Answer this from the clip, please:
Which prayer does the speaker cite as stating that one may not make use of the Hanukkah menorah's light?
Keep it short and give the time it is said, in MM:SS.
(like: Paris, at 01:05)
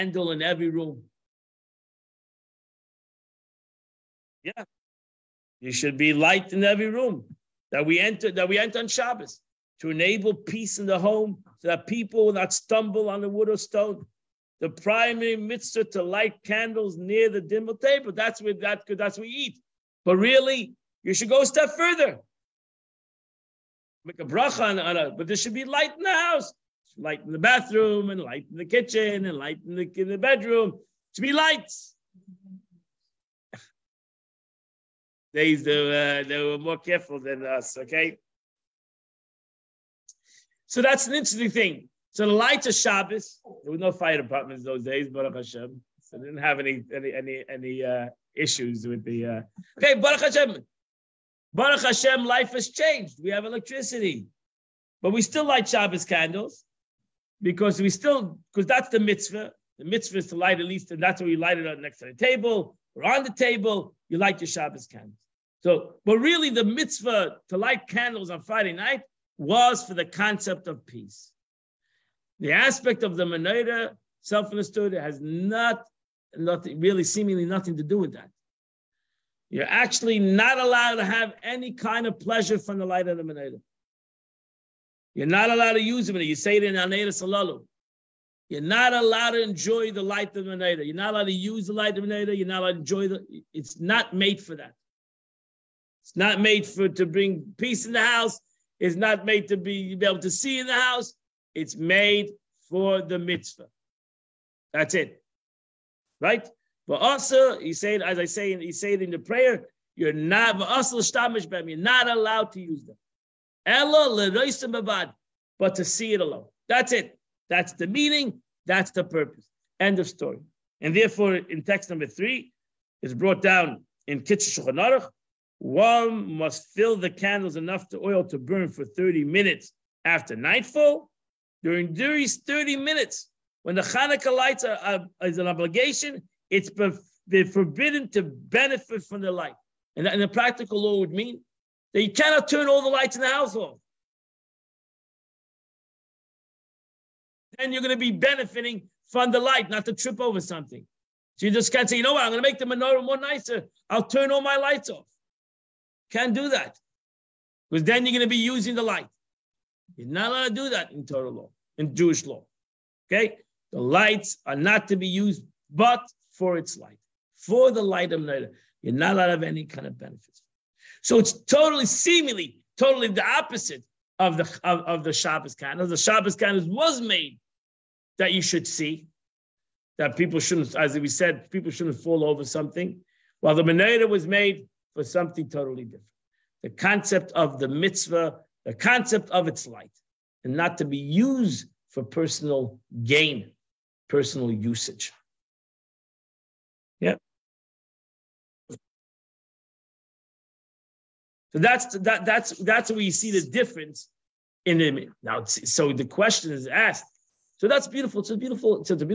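Haneiros Halalu, at 01:26.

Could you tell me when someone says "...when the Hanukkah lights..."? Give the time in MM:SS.
02:13.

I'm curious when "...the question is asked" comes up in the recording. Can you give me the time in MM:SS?
03:25.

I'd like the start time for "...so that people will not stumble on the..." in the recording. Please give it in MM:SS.
00:11.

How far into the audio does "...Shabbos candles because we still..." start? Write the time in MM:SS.
00:55.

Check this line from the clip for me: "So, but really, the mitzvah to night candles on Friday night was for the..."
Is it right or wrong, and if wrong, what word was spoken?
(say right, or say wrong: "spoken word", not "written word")
wrong: "light", not "night".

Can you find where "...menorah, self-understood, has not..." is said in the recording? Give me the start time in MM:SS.
01:13.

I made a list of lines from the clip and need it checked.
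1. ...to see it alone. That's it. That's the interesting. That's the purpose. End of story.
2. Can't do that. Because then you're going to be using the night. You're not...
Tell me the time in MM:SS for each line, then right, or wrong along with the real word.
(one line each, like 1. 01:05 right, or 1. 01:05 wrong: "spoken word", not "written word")
1. 01:55 wrong: "meaning", not "interesting"
2. 02:36 wrong: "light", not "night".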